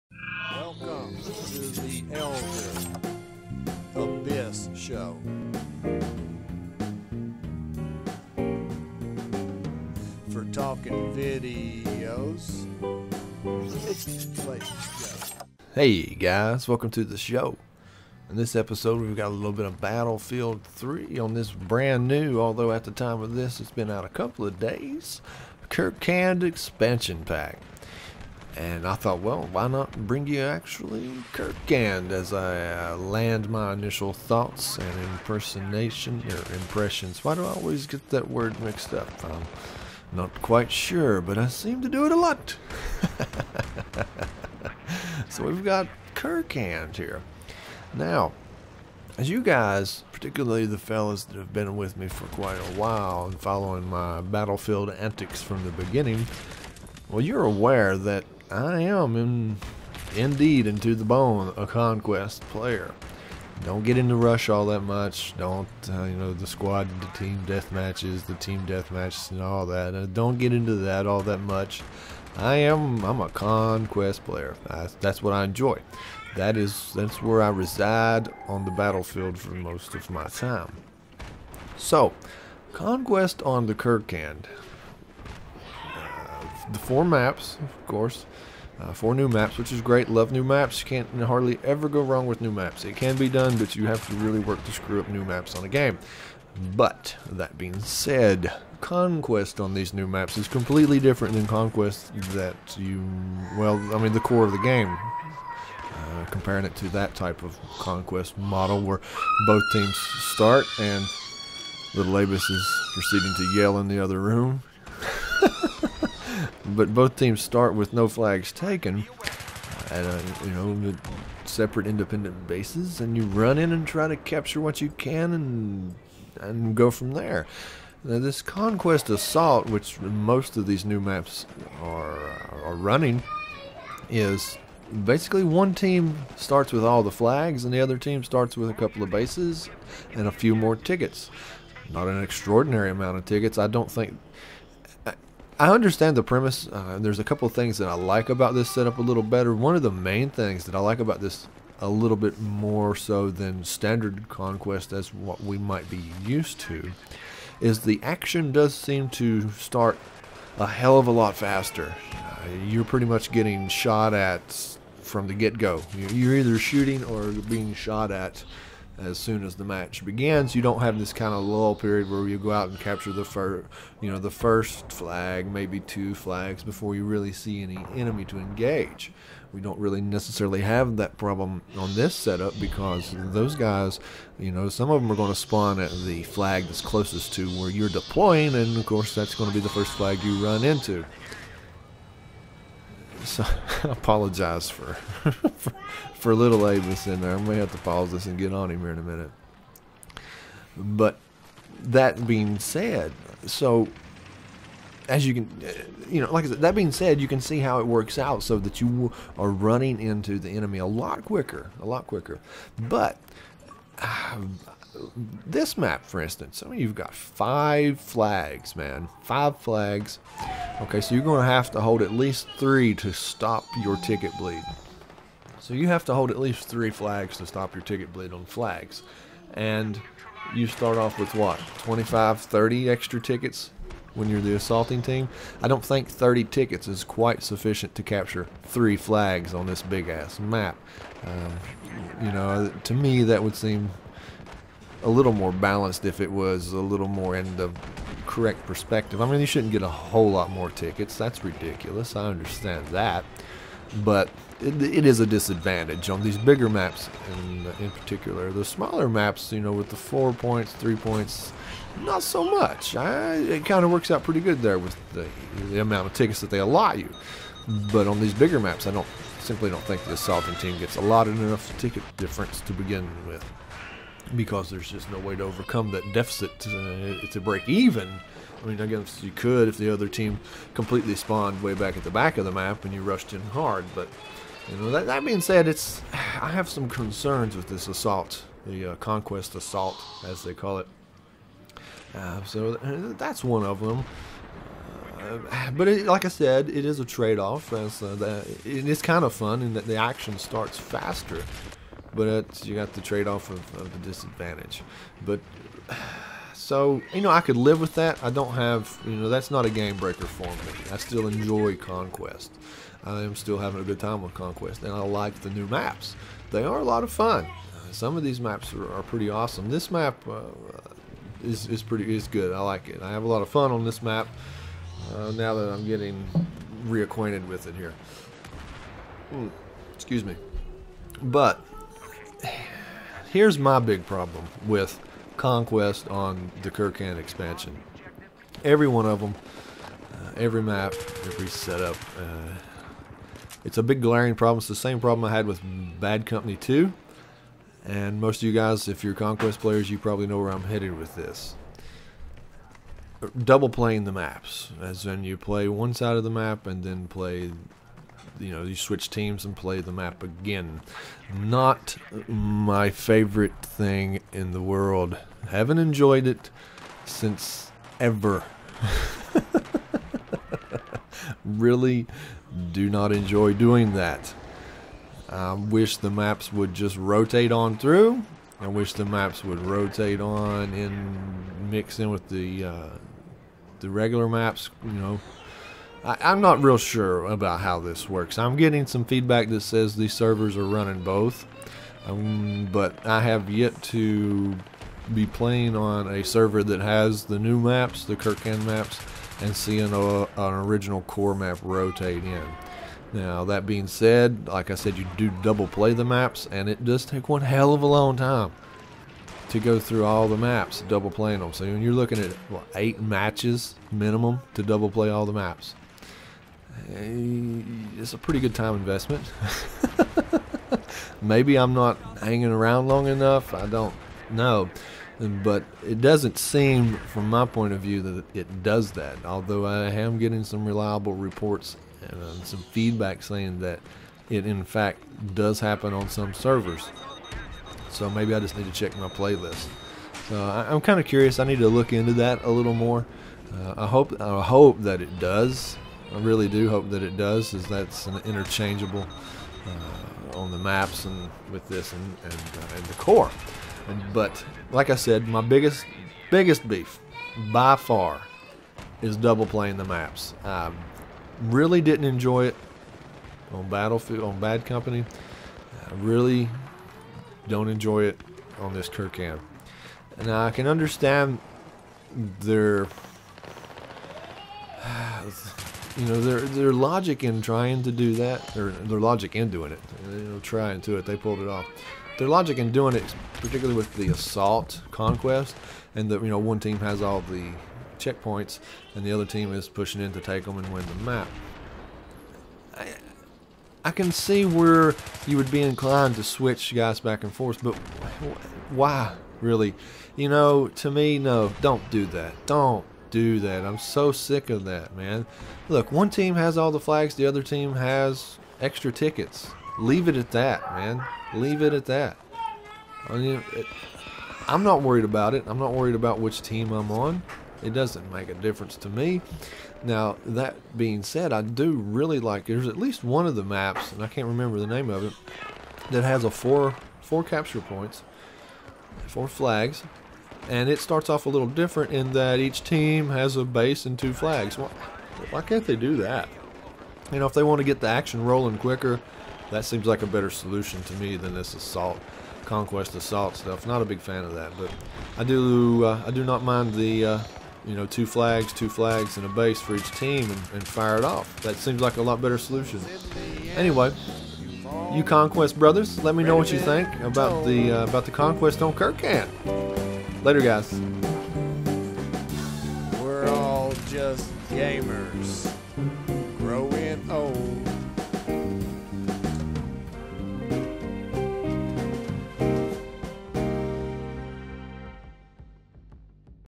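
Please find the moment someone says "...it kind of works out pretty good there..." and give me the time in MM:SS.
04:23.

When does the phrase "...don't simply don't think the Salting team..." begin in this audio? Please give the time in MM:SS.
04:28.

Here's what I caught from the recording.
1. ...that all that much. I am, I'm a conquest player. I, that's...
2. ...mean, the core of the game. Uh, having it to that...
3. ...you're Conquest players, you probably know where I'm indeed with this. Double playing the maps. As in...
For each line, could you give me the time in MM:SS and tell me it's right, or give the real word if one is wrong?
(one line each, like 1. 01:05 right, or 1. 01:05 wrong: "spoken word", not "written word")
1. 01:10 right
2. 01:43 wrong: "comparing", not "having"
3. 05:49 wrong: "headed", not "indeed".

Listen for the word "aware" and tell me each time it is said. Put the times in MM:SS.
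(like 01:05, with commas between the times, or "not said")
00:57.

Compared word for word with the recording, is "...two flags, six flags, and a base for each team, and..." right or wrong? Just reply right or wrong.
wrong.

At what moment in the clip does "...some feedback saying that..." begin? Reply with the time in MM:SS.
07:12.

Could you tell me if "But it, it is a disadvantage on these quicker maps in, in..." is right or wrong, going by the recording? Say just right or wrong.
wrong.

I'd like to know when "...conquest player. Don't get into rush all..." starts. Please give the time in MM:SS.
01:01.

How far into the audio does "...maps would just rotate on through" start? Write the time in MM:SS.
06:16.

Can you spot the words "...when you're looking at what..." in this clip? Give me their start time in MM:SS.
06:51.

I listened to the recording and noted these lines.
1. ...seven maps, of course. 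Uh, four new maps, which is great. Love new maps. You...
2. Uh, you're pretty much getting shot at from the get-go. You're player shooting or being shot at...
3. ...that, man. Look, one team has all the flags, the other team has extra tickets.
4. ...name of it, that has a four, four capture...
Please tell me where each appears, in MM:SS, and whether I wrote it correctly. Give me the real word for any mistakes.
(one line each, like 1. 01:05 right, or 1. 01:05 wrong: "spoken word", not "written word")
1. 01:26 wrong: "four", not "seven"
2. 02:42 wrong: "either", not "player"
3. 08:24 right
4. 08:44 right.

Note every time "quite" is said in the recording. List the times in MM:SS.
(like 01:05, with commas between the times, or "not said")
00:40, 00:52, 03:57.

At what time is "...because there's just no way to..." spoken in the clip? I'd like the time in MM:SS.
04:34.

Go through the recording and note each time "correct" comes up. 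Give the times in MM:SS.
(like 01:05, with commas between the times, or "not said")
04:08.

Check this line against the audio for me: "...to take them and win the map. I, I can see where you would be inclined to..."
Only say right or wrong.
right.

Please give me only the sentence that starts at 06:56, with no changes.
Eh, it's a pretty good time investment.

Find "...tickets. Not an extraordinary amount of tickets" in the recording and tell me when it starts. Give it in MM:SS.
02:20.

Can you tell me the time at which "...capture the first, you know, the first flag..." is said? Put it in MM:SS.
02:52.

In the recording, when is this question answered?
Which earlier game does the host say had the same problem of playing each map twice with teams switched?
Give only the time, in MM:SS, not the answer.
05:45.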